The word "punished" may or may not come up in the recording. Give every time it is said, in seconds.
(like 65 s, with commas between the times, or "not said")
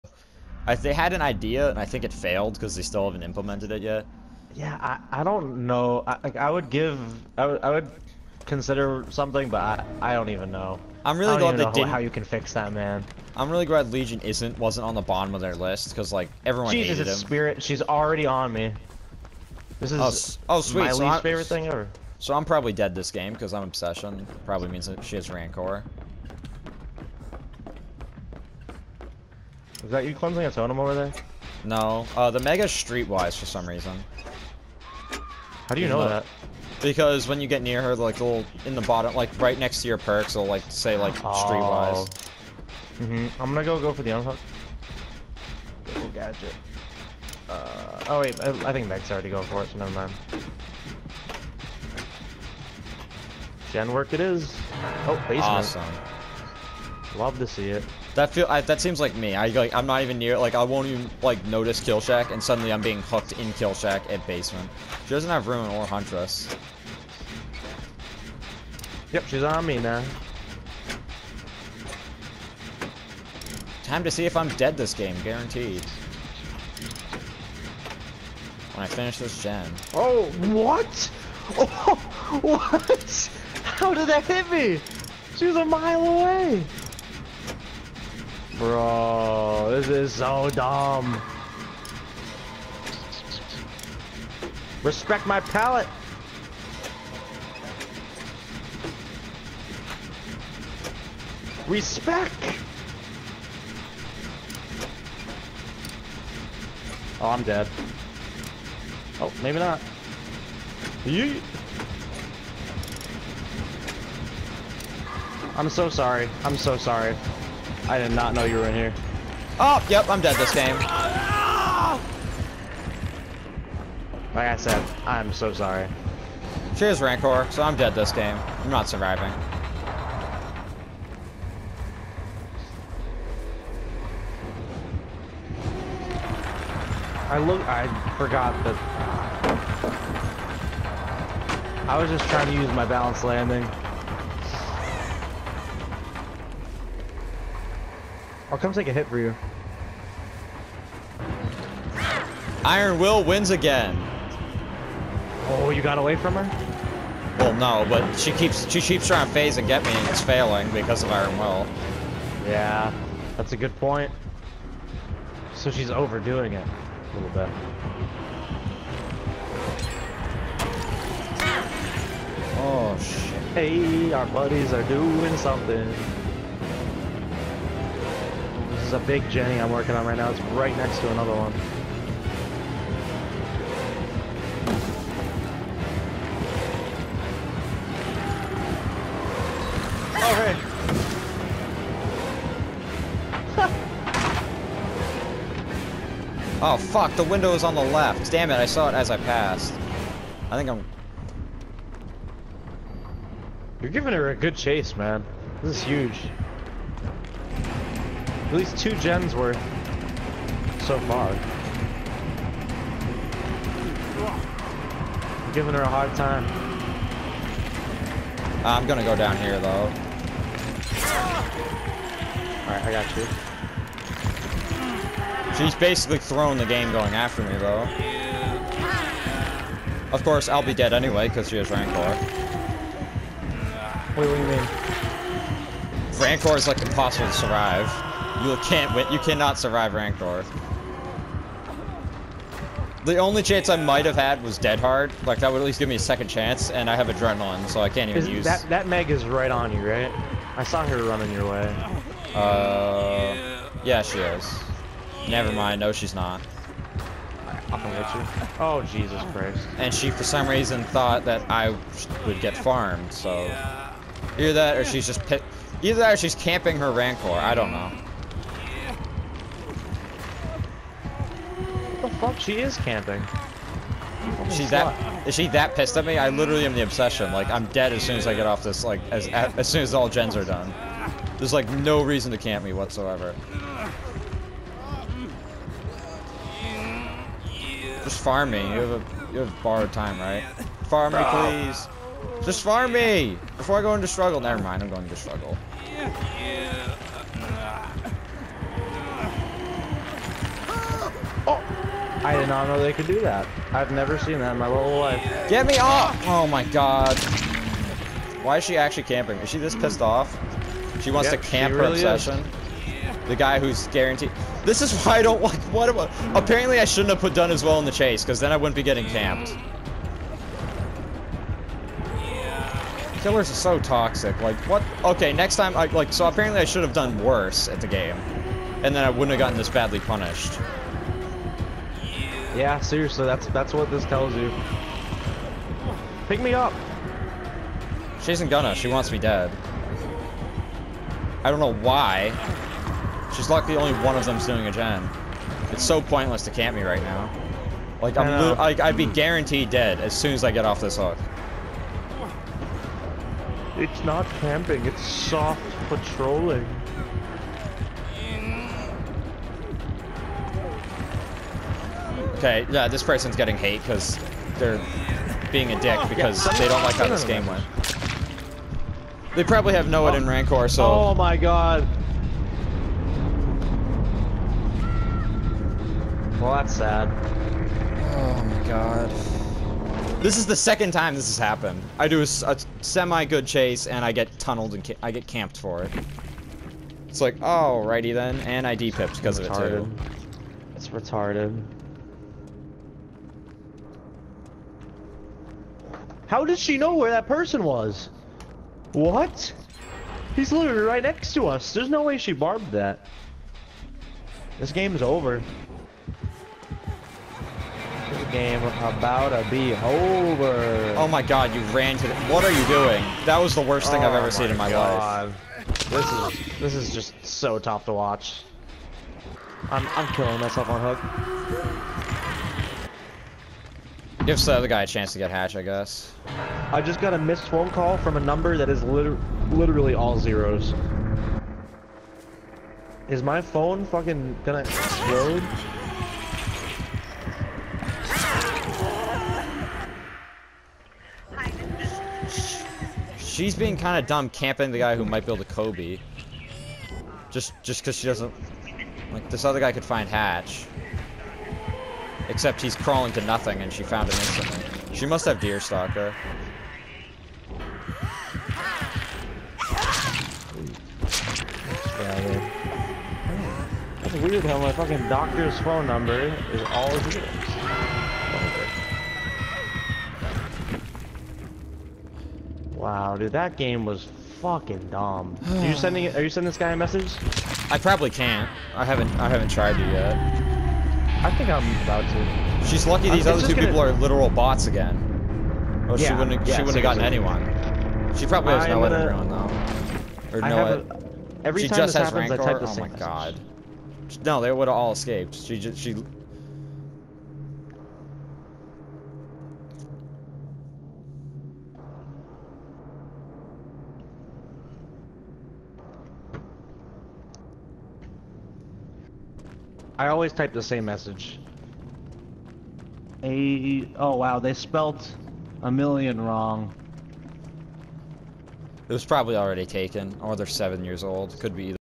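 329 s.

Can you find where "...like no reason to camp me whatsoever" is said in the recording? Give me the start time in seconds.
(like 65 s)
281 s.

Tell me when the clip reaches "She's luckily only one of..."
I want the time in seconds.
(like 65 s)
343 s.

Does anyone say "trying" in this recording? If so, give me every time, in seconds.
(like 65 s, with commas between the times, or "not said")
142 s, 159 s.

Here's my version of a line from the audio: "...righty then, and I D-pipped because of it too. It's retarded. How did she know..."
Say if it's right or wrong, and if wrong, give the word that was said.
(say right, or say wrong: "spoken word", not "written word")
right.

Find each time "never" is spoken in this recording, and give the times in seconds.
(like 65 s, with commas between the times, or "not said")
49 s, 255 s, 294 s, 303 s.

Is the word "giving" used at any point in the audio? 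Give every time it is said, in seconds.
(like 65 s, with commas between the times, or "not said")
203 s, 215 s.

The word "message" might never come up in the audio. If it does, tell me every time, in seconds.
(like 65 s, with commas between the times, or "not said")
476 s, 492 s, 510 s.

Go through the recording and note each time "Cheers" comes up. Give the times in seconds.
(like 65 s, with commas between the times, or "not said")
126 s.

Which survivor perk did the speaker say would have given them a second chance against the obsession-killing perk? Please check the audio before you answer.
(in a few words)
Dead Hard.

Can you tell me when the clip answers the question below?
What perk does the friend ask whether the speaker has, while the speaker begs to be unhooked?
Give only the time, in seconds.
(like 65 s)
289 s.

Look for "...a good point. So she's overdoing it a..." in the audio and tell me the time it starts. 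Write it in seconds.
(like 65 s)
163 s.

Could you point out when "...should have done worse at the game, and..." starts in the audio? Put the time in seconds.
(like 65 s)
326 s.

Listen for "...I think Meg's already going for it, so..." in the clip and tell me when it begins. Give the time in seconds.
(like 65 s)
48 s.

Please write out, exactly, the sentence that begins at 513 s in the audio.
A oh wow, they spelt a million wrong.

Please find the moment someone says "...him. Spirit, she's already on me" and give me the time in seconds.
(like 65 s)
17 s.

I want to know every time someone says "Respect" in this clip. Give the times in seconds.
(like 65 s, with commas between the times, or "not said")
94 s, 101 s.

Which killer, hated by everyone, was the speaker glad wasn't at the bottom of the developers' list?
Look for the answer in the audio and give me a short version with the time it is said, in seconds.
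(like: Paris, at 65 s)
Legion, at 13 s.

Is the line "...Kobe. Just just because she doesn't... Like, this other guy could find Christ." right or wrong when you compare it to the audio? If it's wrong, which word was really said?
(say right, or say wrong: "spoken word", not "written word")
wrong: "Hatch", not "Christ".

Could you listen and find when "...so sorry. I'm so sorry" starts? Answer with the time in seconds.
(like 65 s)
115 s.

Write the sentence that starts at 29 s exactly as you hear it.
Is that you cleansing a totem over there?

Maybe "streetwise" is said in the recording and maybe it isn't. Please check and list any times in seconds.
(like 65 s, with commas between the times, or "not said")
32 s, 41 s.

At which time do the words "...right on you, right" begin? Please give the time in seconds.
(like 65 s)
249 s.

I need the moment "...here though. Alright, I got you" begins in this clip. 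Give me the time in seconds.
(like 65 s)
219 s.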